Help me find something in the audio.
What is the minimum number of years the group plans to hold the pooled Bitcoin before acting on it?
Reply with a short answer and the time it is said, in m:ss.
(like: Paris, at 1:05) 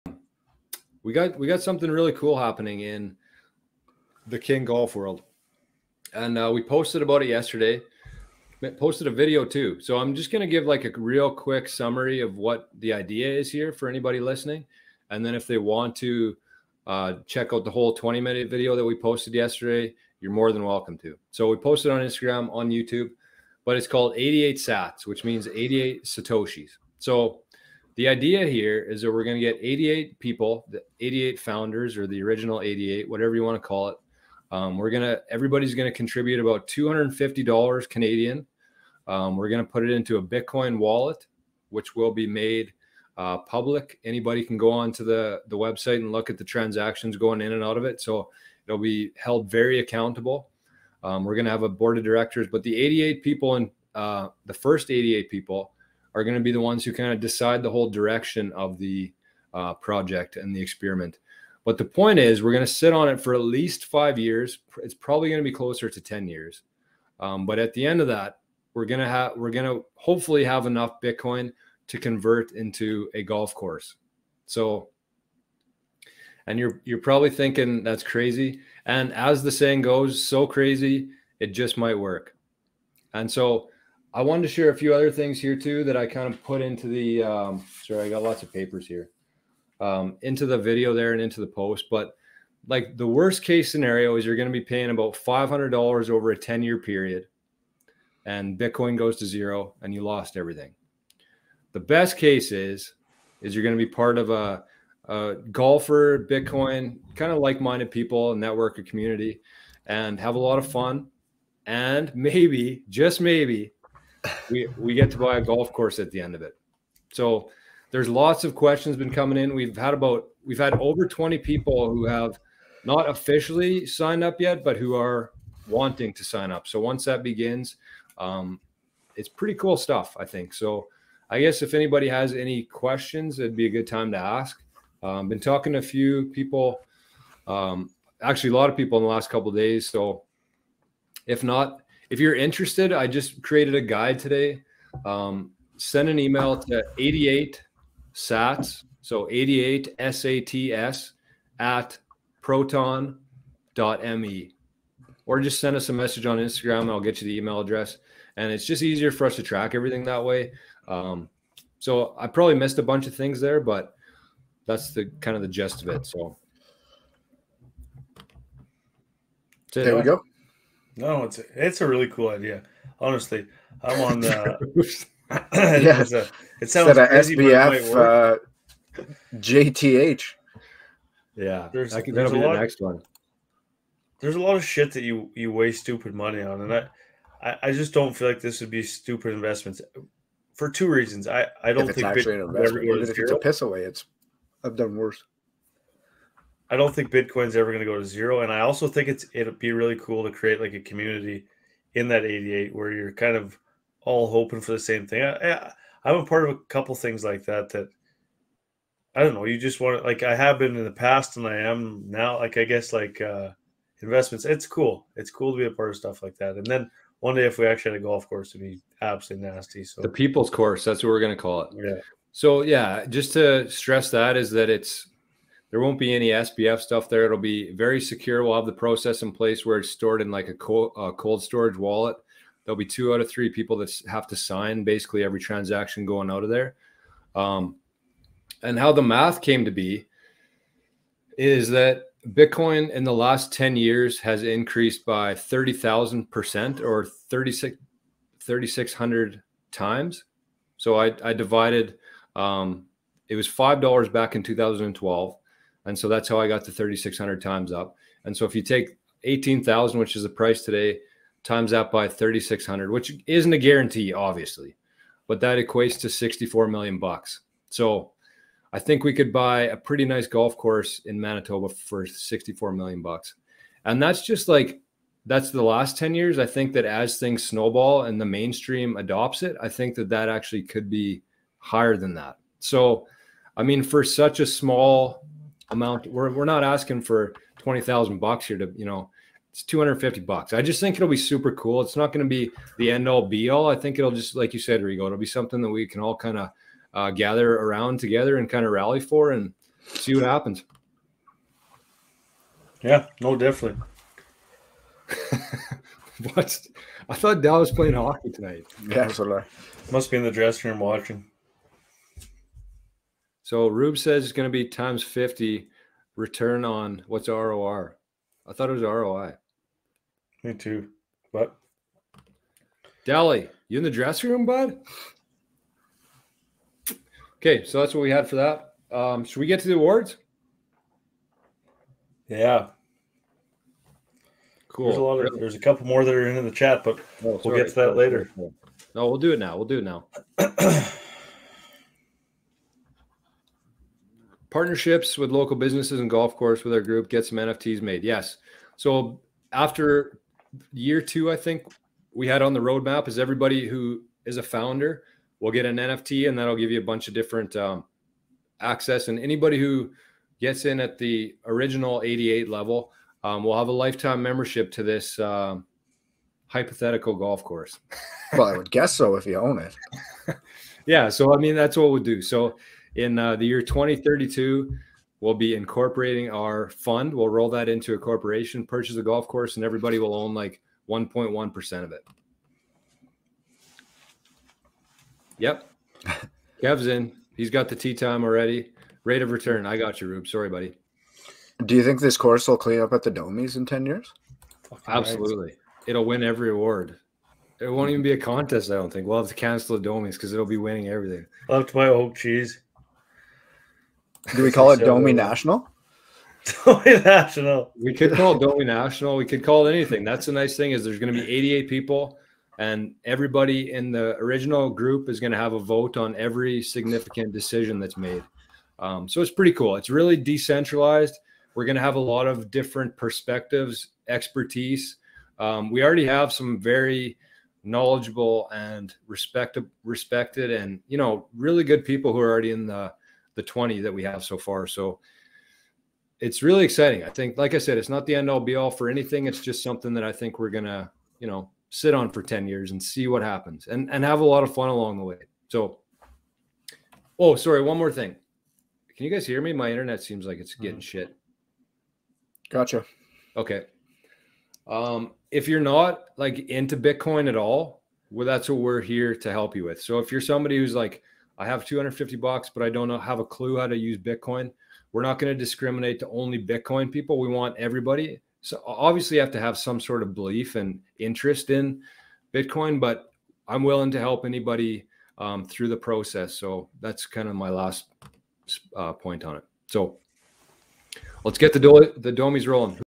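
5, at 1:03.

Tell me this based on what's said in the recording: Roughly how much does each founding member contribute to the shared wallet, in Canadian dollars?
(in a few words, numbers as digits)
$250.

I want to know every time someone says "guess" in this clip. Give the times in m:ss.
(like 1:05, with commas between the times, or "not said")
2:11, 3:32, 6:08.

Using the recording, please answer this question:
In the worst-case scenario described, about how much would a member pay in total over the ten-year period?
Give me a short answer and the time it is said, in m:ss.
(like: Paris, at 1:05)
$500, at 1:35.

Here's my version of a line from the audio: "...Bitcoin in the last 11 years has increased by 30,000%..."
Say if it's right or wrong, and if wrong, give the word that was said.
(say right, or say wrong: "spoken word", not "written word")
wrong: "10", not "11".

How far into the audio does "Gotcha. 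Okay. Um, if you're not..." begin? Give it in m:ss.
7:32.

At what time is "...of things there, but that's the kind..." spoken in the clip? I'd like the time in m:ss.
2:43.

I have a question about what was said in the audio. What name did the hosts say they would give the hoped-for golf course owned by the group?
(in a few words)
The people's course.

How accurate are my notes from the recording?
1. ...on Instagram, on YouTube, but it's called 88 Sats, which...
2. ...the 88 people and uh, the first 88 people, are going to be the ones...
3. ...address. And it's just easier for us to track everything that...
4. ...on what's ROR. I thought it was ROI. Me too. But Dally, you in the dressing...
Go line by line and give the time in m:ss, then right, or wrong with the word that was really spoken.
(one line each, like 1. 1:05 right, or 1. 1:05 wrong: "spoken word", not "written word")
1. 0:21 right
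2. 0:52 right
3. 2:37 right
4. 5:16 right.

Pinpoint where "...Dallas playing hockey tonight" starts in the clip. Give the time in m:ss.
5:07.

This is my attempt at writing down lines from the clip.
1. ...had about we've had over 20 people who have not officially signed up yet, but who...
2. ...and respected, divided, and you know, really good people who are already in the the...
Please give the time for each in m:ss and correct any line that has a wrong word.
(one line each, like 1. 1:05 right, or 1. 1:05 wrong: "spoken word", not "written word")
1. 1:59 right
2. 7:08 wrong: "respected", not "divided".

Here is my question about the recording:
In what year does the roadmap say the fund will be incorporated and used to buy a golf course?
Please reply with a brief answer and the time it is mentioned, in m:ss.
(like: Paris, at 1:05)
2032, at 6:13.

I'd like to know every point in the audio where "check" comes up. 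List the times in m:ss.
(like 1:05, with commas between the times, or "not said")
0:17.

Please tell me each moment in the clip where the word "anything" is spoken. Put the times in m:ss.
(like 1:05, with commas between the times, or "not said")
6:49, 7:18.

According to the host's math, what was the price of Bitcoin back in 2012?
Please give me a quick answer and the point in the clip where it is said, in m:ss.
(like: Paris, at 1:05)
$5, at 4:13.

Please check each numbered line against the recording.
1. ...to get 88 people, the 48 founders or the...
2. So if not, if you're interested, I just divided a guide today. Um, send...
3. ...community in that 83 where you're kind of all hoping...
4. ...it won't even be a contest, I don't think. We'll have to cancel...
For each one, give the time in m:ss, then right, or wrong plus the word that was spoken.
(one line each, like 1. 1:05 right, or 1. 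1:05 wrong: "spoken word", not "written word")
1. 0:29 wrong: "88", not "48"
2. 2:19 wrong: "created", not "divided"
3. 3:20 wrong: "88", not "83"
4. 6:37 right.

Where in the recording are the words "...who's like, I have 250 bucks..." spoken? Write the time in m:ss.
7:40.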